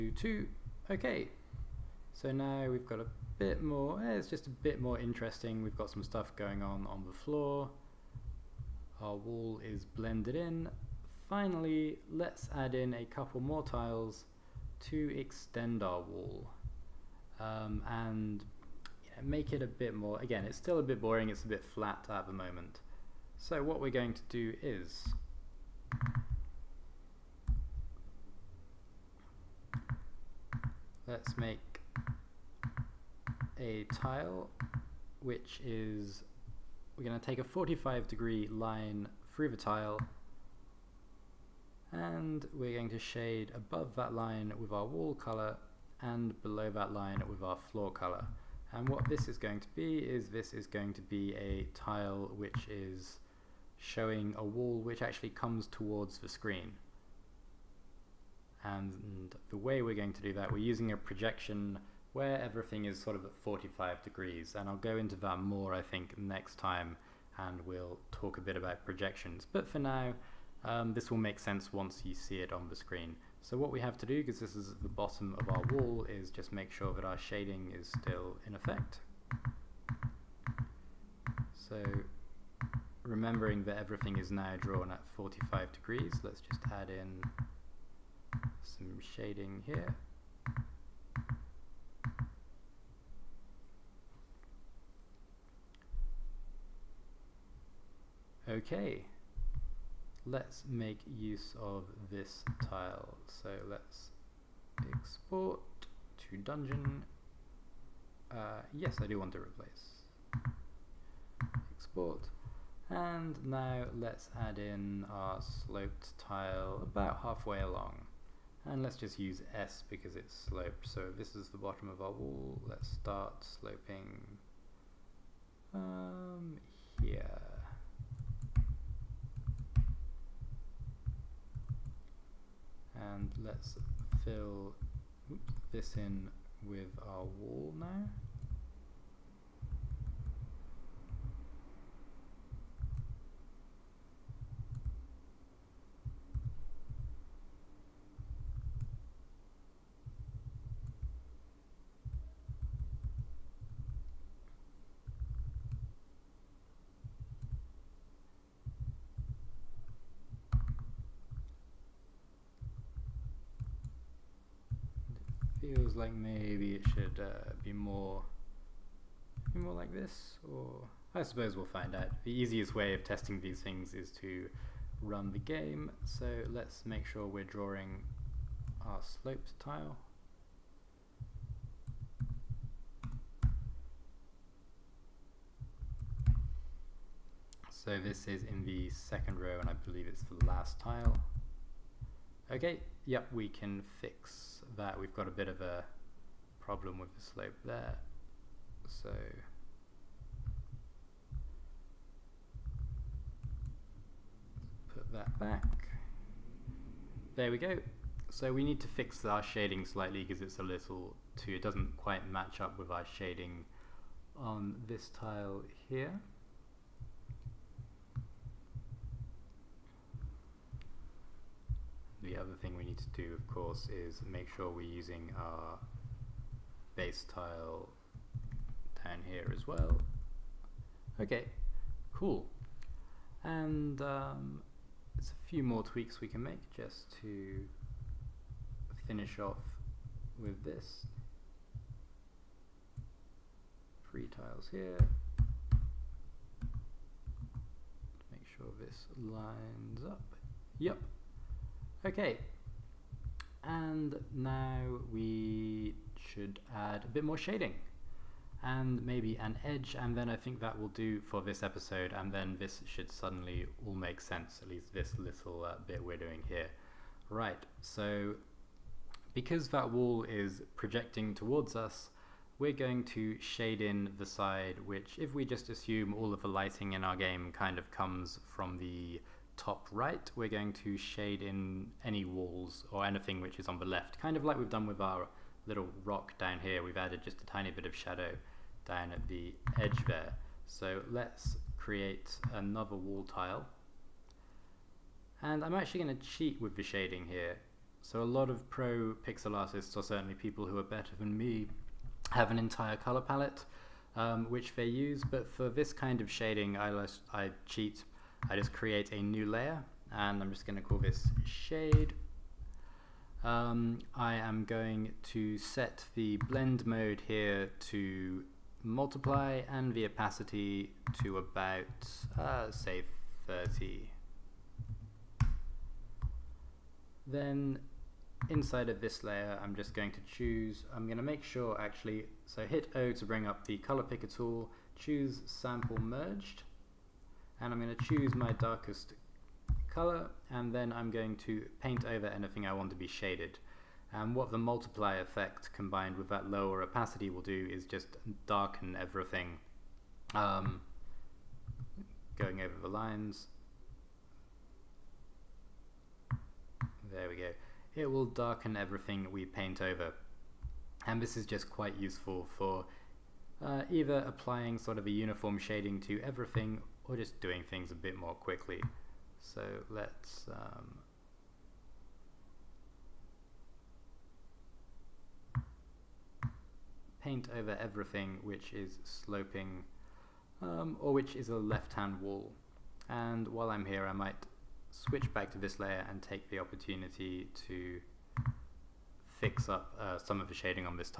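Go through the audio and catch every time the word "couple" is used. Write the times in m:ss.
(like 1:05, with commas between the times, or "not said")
0:13.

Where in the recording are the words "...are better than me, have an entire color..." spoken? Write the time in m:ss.
5:00.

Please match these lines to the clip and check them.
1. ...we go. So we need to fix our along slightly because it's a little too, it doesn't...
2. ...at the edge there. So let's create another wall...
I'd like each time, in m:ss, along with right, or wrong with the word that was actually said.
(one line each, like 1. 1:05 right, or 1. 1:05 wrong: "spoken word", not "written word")
1. 3:27 wrong: "shading", not "along"
2. 4:49 right.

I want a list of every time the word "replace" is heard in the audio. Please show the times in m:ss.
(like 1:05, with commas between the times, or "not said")
1:49.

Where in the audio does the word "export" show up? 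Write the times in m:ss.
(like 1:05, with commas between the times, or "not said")
1:44, 1:51.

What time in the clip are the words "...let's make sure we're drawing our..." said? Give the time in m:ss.
2:56.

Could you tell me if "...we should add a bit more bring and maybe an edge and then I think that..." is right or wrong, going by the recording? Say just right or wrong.
wrong.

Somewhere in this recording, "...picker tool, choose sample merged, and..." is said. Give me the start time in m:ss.
5:34.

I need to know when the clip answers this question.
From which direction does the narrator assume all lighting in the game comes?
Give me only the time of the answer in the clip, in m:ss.
4:39.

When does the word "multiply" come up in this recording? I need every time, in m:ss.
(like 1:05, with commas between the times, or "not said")
5:18, 5:44.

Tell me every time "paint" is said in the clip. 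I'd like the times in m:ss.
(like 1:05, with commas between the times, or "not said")
5:41, 5:59, 6:17.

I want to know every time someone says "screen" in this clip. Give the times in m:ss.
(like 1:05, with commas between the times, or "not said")
0:56, 1:12.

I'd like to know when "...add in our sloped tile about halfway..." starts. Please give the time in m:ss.
1:54.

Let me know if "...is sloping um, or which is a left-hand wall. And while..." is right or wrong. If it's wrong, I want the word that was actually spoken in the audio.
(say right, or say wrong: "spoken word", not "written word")
right.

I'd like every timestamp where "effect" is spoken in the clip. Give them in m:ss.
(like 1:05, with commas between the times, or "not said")
1:18, 5:45.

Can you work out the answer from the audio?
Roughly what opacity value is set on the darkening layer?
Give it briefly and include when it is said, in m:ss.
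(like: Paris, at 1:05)
30, at 5:23.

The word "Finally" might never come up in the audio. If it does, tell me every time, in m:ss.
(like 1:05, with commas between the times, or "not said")
0:11.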